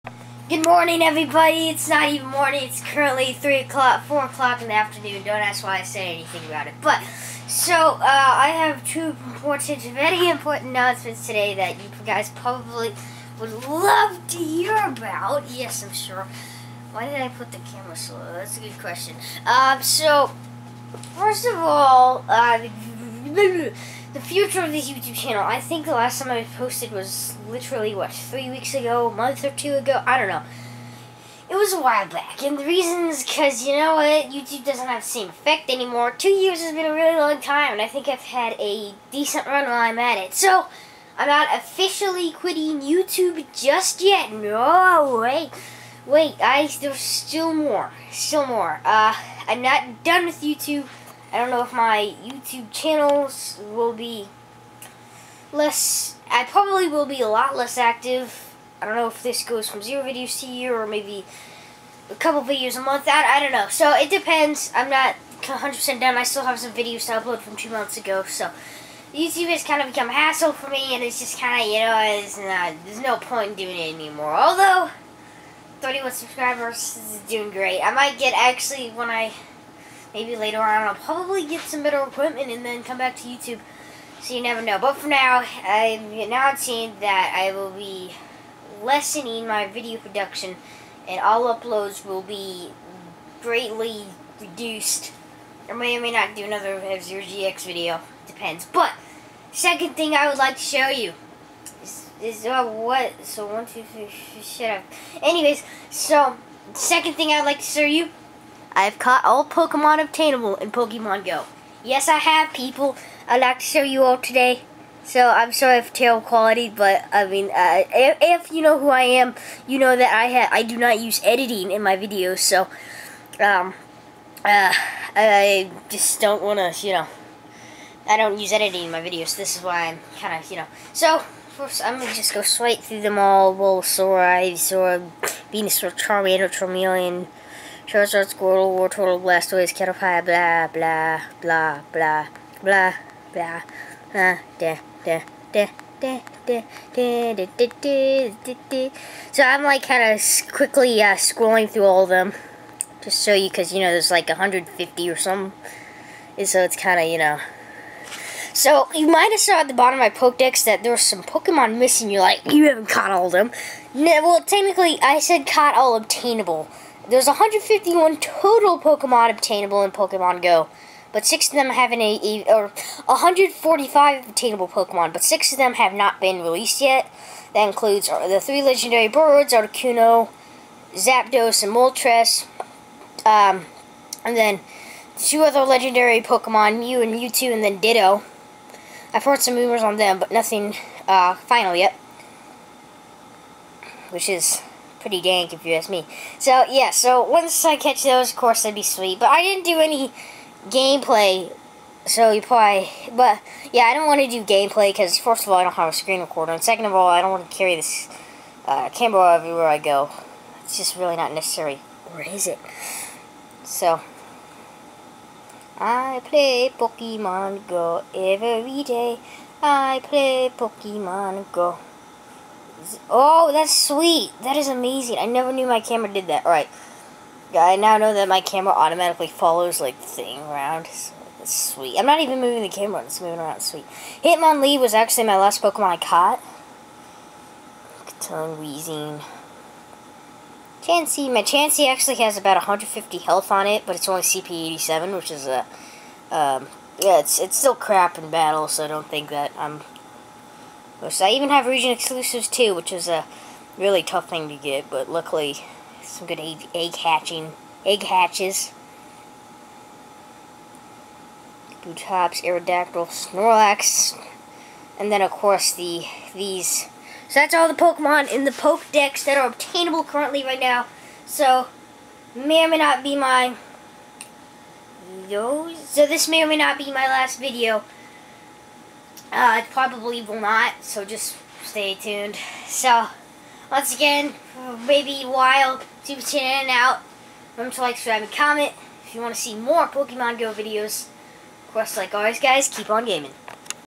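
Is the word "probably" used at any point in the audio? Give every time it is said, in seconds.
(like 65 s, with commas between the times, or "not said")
12 s, 56 s, 80 s, 202 s, 279 s.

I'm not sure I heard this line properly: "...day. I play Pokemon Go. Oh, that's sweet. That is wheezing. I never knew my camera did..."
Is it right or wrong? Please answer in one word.
wrong.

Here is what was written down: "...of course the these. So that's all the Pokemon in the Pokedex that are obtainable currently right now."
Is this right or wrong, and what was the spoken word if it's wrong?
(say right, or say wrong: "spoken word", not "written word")
right.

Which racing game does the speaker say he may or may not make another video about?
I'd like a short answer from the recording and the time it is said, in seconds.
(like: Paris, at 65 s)
F-Zero GX, at 96 s.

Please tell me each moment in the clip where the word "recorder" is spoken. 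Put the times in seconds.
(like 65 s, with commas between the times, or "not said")
206 s.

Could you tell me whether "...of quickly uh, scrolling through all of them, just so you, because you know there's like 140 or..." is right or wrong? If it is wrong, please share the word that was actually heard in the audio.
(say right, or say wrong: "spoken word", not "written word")
wrong: "150", not "140".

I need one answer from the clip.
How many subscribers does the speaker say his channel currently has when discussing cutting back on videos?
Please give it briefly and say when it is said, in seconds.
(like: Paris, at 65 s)
31, at 75 s.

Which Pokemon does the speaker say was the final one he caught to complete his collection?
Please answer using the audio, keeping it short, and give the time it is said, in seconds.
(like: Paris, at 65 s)
Hitmonlee, at 234 s.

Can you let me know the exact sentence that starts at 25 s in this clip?
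I think the last time I posted was literally, what, three weeks ago, a month or two ago?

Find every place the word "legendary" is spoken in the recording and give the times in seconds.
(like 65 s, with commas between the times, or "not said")
178 s, 185 s.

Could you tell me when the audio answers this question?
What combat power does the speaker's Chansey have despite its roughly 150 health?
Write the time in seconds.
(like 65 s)
244 s.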